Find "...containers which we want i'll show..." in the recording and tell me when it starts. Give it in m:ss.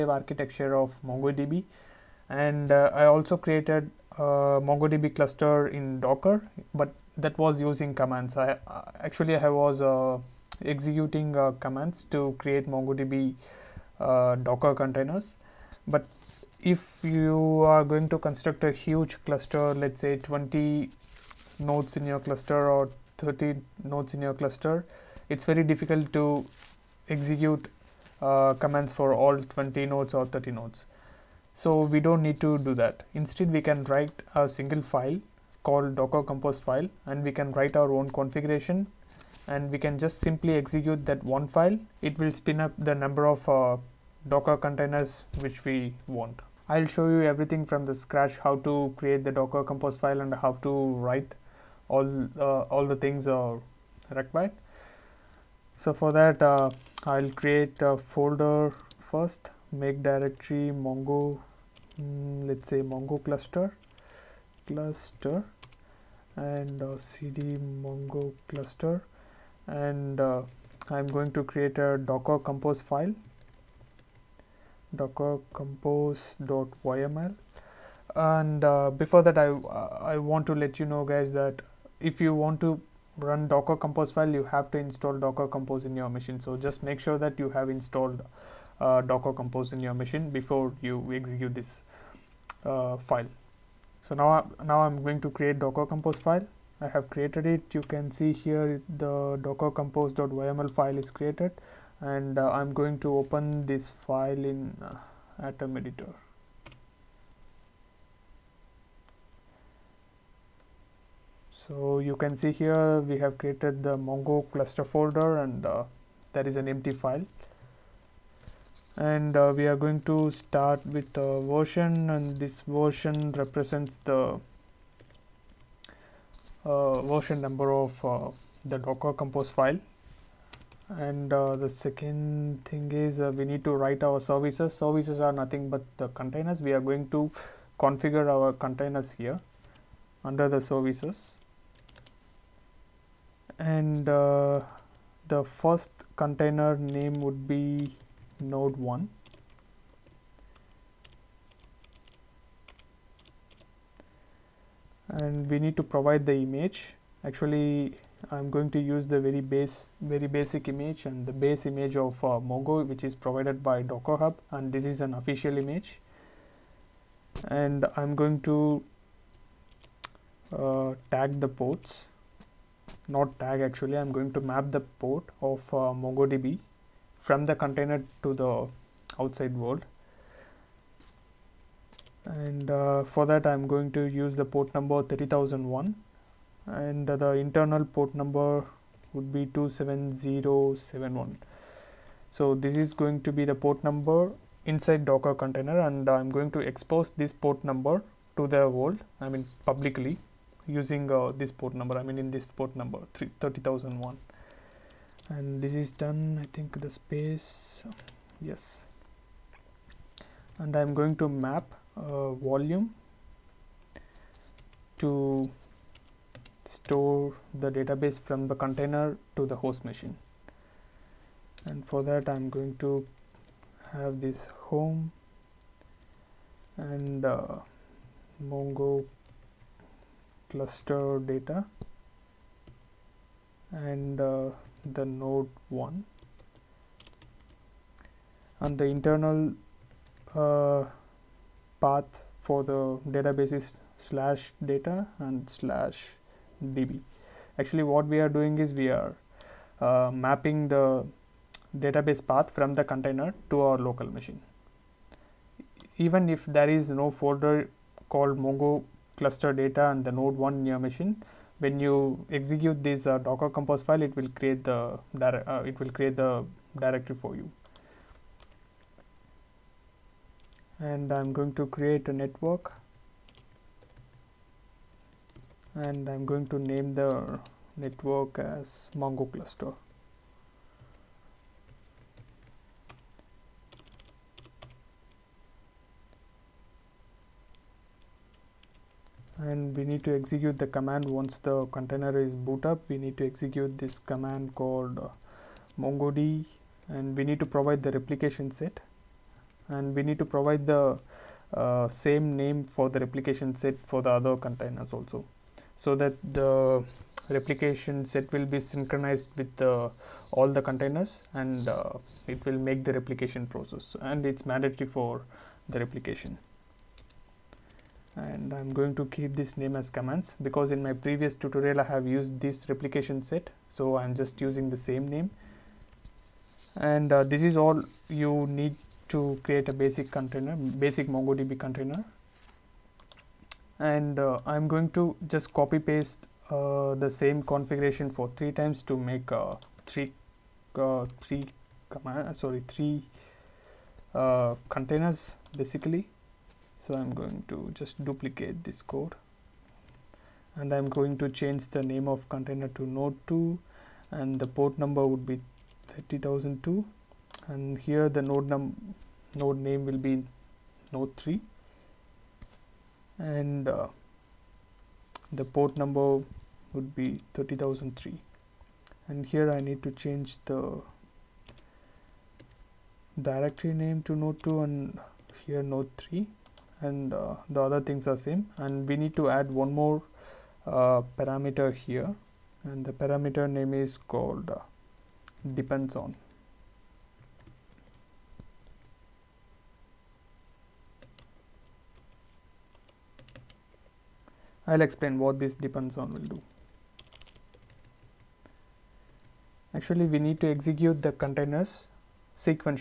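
0:44.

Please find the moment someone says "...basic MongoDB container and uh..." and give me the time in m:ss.
5:30.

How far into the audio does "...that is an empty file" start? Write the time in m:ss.
1:56.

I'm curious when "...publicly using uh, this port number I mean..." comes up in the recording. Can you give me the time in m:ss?
3:19.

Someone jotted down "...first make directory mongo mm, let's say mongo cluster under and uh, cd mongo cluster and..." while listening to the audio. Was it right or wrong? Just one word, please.
wrong.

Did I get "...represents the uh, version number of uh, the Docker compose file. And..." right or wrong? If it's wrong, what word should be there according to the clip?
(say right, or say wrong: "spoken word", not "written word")
right.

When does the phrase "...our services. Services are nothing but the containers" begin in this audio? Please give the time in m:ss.
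2:14.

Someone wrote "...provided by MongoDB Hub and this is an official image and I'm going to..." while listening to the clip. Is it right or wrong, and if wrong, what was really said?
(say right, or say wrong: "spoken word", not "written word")
wrong: "Docker", not "MongoDB".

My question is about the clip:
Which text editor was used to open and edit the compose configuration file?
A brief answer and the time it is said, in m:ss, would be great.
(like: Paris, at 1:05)
Atom, at 1:45.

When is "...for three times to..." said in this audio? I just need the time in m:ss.
5:38.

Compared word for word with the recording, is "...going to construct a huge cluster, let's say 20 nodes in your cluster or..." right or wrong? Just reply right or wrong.
right.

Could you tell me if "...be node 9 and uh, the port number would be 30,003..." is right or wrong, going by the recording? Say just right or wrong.
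wrong.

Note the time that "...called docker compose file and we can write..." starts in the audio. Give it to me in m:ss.
0:35.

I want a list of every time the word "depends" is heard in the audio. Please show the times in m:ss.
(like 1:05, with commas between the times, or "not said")
6:25, 6:35.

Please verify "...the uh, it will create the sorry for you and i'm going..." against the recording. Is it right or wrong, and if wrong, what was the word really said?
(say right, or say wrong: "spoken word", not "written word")
wrong: "directory", not "sorry".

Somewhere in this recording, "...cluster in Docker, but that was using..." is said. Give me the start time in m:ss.
0:05.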